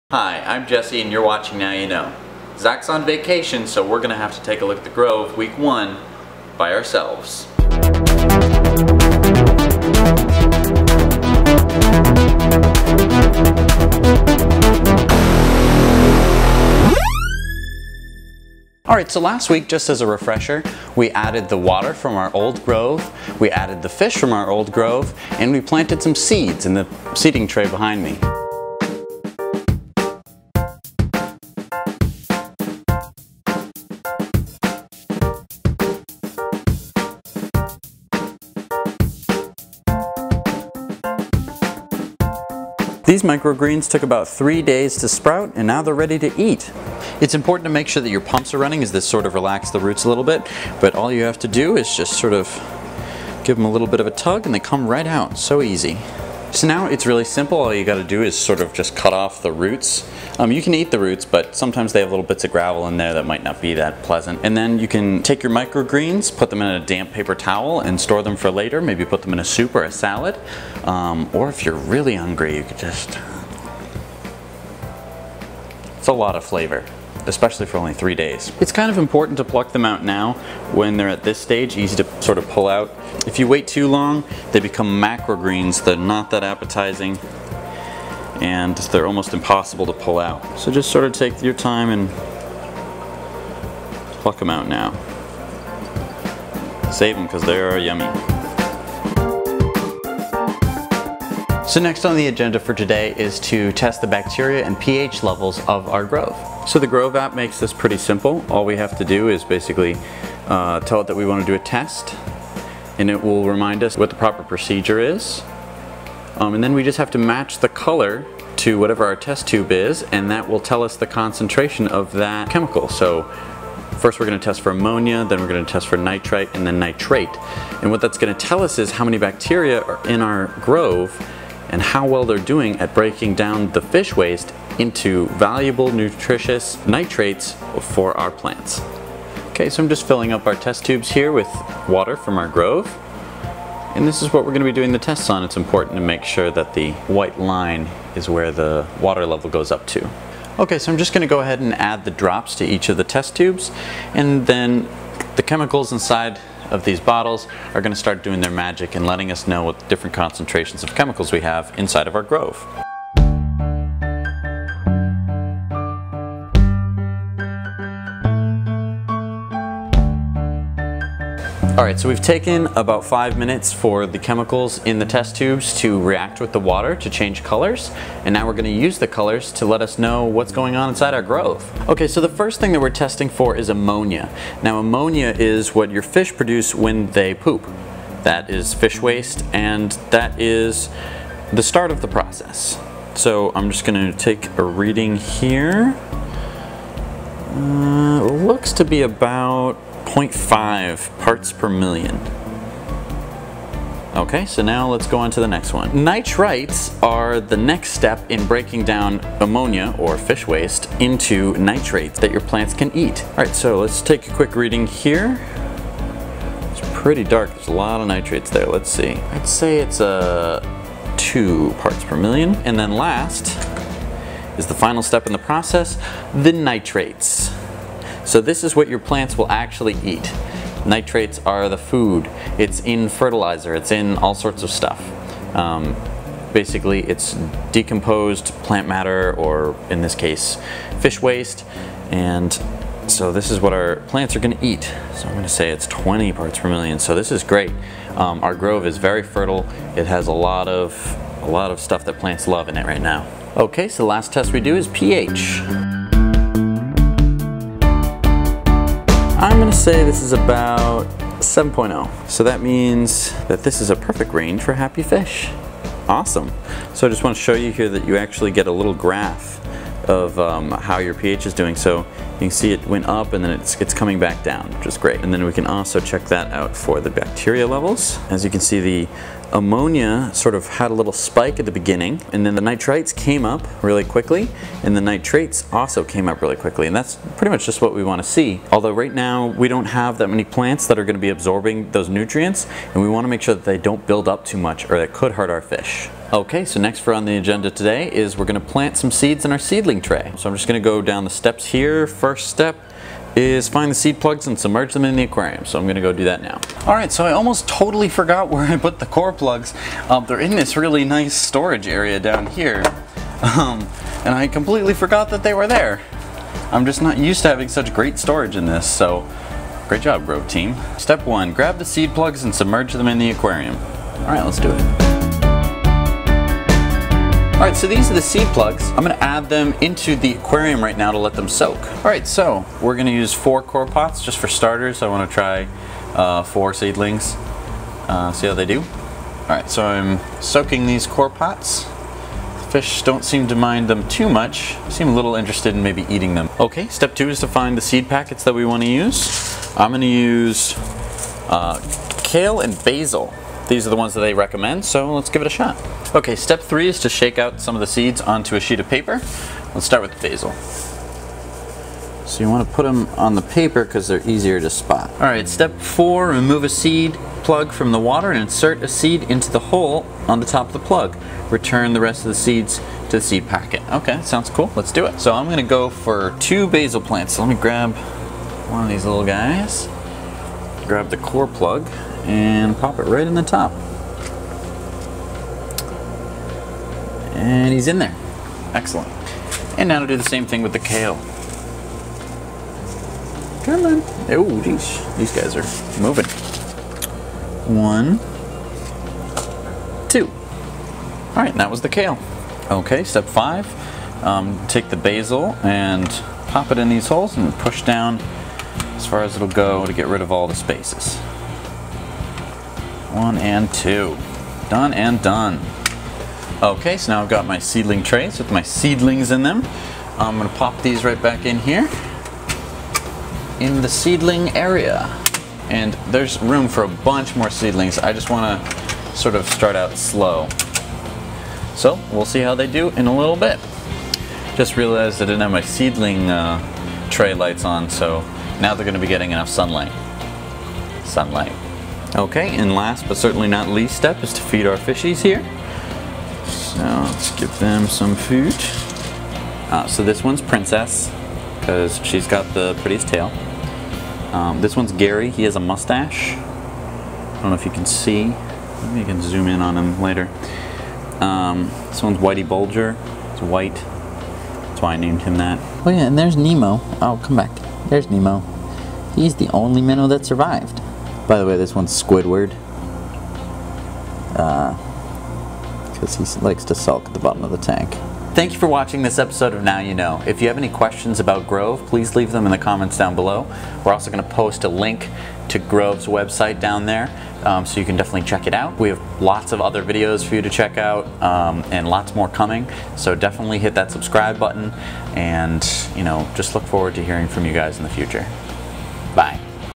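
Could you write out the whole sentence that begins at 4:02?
And so this is what our plants are going to eat.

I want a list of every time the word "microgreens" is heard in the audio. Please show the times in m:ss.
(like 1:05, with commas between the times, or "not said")
0:43, 1:05.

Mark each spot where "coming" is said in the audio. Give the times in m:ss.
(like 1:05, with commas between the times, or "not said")
4:33, 8:12.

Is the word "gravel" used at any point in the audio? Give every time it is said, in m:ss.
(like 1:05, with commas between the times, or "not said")
1:02.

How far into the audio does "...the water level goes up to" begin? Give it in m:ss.
2:28.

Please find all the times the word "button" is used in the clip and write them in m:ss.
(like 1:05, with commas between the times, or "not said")
8:14.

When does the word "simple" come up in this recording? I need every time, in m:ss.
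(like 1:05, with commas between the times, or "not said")
0:57, 1:47.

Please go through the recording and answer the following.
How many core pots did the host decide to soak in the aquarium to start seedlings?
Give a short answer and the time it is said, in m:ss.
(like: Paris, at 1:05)
4, at 5:33.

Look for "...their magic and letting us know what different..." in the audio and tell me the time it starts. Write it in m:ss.
2:38.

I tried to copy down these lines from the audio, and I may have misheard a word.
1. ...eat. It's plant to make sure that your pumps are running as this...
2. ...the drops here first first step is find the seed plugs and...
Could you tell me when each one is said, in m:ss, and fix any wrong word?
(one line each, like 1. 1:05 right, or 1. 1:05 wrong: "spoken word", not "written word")
1. 0:46 wrong: "important", not "plant"
2. 5:01 wrong: "steps", not "drops".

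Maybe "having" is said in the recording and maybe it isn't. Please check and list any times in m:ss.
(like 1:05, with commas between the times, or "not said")
5:17.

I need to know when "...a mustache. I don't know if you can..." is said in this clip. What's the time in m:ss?
7:35.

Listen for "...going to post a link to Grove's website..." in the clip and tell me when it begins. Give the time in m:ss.
8:04.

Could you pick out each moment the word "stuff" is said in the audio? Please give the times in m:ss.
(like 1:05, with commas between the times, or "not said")
3:54, 4:11.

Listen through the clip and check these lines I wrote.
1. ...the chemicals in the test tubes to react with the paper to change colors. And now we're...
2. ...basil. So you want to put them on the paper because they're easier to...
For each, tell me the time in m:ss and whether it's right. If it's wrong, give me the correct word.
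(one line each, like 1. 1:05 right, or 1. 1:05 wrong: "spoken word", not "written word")
1. 2:54 wrong: "water", not "paper"
2. 6:00 right.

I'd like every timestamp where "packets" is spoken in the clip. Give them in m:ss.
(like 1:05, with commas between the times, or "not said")
5:48, 6:13.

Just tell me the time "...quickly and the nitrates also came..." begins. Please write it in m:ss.
4:44.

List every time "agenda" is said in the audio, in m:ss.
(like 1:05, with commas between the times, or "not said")
1:42, 4:57.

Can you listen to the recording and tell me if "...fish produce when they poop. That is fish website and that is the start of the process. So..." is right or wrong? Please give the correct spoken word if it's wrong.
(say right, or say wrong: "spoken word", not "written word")
wrong: "waste", not "website".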